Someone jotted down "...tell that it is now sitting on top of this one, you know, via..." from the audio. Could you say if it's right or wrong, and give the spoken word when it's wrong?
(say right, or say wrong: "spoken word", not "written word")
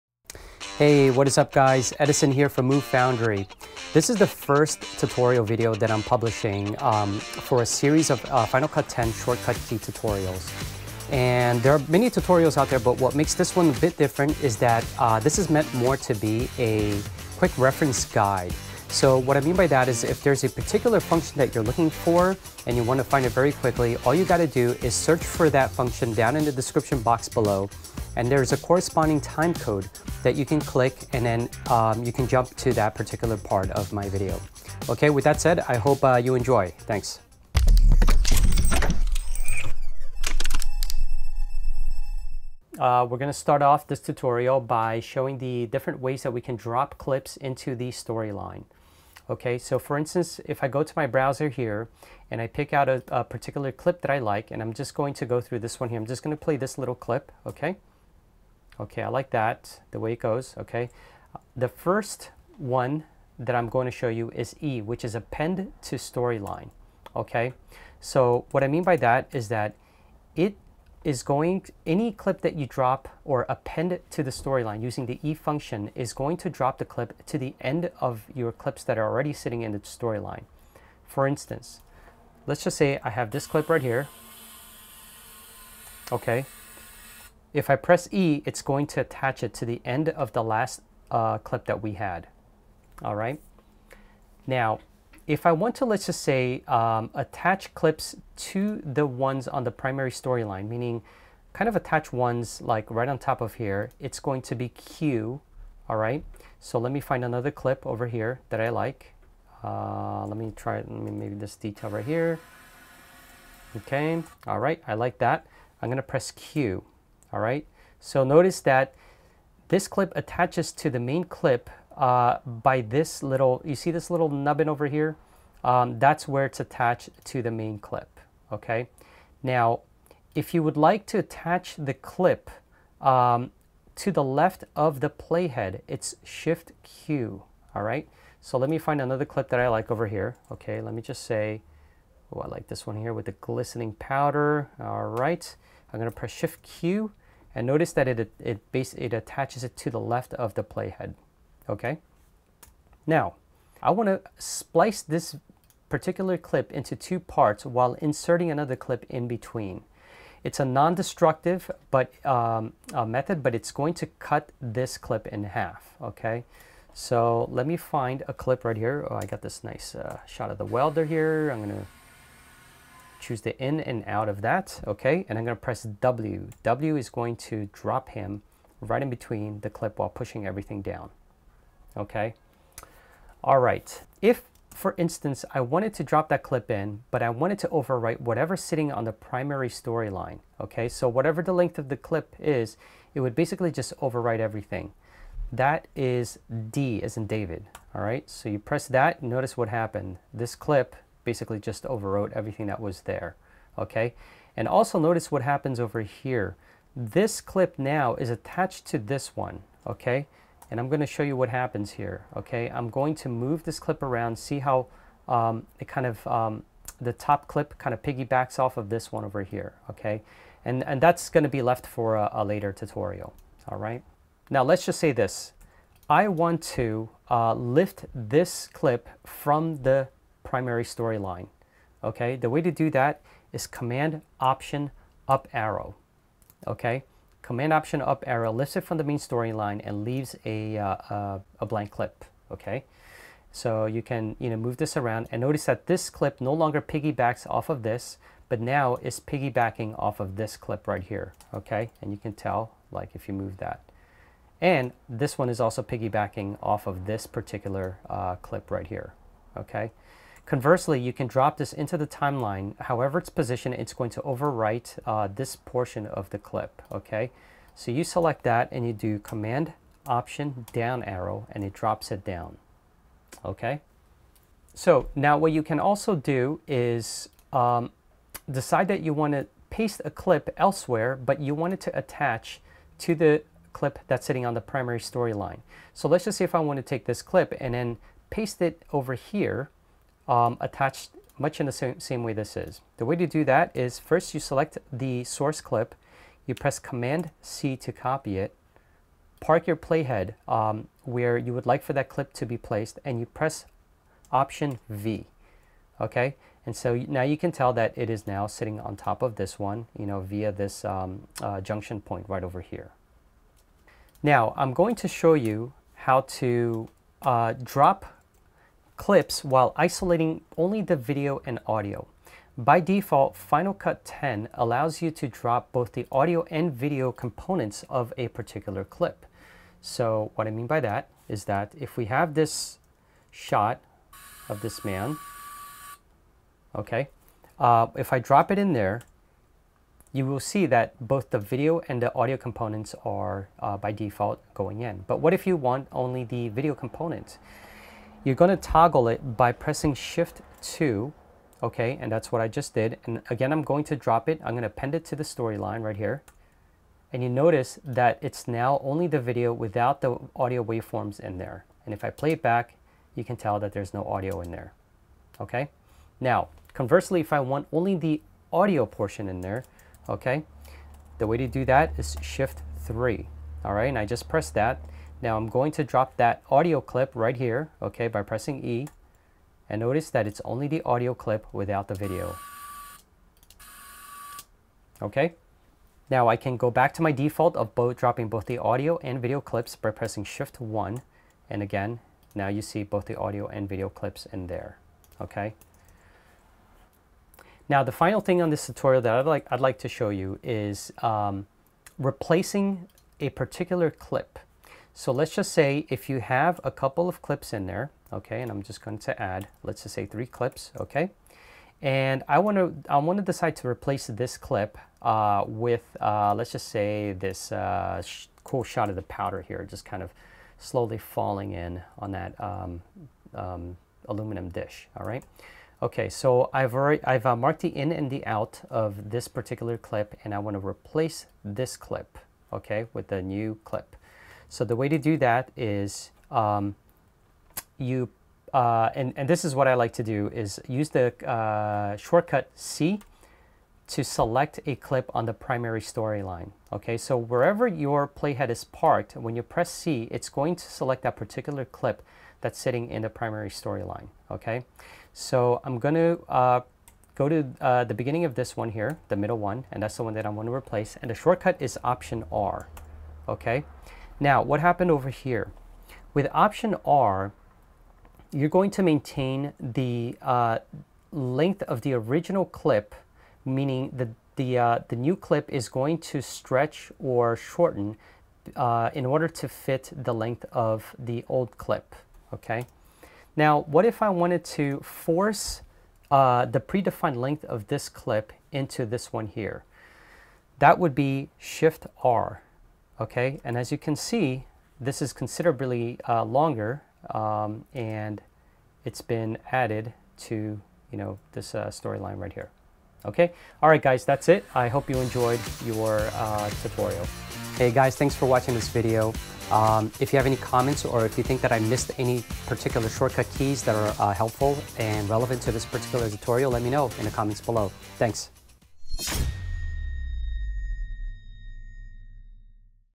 right.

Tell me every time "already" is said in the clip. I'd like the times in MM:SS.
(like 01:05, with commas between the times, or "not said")
01:19, 07:06.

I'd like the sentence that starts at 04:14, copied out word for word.
And this one is also piggybacking off of this particular uh, clip right here.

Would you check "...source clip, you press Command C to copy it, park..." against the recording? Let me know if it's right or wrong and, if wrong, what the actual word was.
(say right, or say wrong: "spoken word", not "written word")
right.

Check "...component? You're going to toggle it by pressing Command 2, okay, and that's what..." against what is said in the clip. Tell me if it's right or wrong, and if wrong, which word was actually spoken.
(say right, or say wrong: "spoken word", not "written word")
wrong: "Shift", not "Command".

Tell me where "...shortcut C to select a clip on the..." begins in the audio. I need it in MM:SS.
07:21.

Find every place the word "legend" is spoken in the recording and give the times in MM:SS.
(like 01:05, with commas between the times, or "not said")
not said.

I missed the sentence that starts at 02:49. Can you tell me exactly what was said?
Oh, I got this nice uh, shot of the welder here.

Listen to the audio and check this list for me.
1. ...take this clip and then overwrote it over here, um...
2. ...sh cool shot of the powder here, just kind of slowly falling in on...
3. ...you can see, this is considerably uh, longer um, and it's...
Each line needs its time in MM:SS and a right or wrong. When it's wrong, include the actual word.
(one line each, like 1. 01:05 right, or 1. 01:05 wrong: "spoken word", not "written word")
1. 04:46 wrong: "paste", not "overwrote"
2. 06:58 right
3. 08:13 right.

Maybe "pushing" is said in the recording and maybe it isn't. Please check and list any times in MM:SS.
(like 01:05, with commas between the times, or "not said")
03:00.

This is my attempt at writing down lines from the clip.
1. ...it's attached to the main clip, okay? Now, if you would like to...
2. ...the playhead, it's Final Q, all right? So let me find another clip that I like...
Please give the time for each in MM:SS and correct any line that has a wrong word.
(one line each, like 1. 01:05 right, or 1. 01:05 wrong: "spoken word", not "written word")
1. 02:06 right
2. 02:14 wrong: "Shift", not "Final".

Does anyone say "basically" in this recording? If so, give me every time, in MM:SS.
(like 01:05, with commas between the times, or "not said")
03:13, 03:21.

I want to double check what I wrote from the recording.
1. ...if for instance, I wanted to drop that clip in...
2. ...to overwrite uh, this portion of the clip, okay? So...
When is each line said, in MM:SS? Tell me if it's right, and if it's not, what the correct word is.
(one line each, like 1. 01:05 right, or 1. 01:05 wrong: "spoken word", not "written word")
1. 03:04 right
2. 04:24 right.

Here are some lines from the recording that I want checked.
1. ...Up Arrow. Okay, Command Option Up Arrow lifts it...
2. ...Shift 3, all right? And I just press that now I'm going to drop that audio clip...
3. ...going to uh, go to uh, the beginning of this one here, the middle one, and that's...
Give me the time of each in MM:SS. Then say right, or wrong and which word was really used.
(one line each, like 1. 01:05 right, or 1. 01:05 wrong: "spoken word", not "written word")
1. 03:55 right
2. 06:12 right
3. 07:35 right.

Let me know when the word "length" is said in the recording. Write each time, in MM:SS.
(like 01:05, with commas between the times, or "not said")
03:11, 07:51, 08:00, 08:07.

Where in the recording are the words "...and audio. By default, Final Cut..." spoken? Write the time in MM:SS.
05:21.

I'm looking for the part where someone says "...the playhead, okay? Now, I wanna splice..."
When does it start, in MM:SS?
02:30.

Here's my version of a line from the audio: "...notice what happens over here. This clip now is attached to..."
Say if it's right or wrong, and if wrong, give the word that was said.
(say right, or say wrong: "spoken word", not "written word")
right.